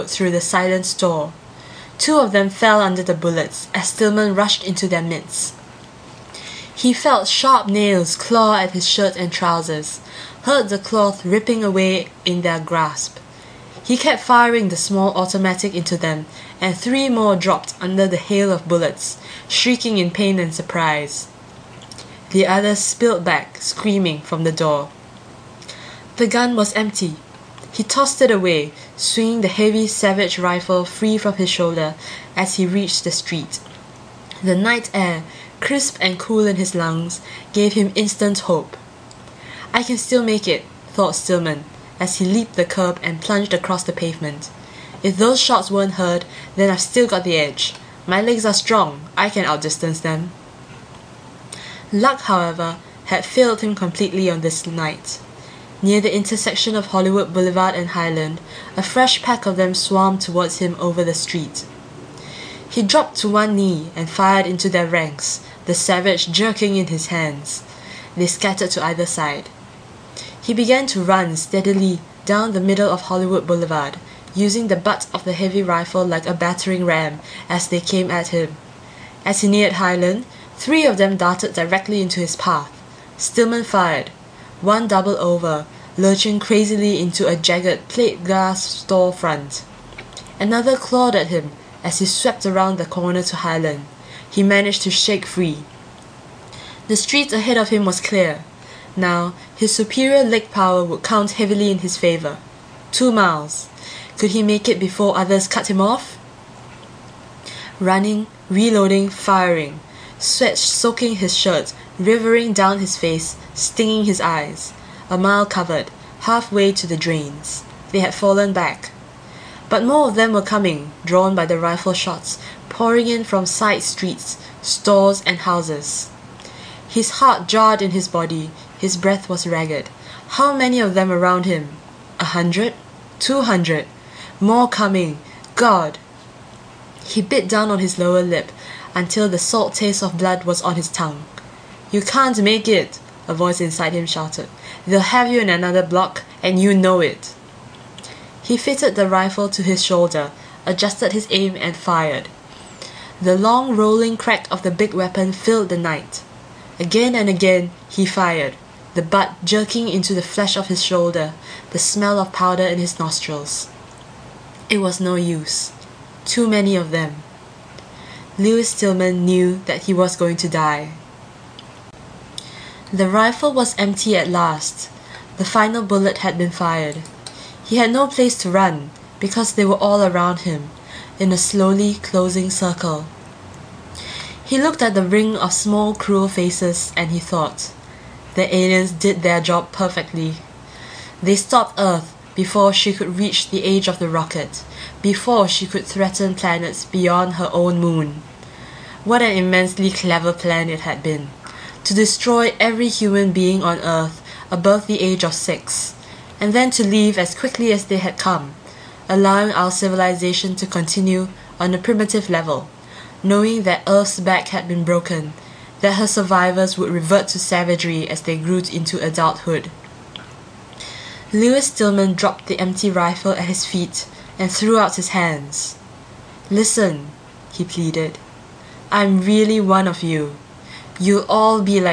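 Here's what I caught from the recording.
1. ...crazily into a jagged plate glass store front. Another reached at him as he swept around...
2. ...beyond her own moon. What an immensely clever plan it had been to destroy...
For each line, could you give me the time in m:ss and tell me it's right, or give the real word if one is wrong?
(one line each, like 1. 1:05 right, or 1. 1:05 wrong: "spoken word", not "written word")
1. 1:26 wrong: "clawed", not "reached"
2. 3:16 right.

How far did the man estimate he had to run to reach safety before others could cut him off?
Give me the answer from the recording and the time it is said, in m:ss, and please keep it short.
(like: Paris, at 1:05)
2 miles, at 1:42.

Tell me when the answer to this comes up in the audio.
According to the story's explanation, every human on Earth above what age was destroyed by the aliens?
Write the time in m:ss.
3:25.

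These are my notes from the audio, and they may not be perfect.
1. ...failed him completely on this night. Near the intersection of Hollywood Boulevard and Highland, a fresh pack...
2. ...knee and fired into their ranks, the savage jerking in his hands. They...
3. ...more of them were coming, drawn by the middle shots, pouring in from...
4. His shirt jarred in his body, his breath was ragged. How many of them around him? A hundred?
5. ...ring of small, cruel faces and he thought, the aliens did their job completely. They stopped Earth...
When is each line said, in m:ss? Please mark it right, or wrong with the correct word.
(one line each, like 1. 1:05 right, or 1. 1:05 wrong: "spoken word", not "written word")
1. 0:53 right
2. 1:03 right
3. 1:59 wrong: "rifle", not "middle"
4. 2:06 wrong: "heart", not "shirt"
5. 3:05 wrong: "perfectly", not "completely".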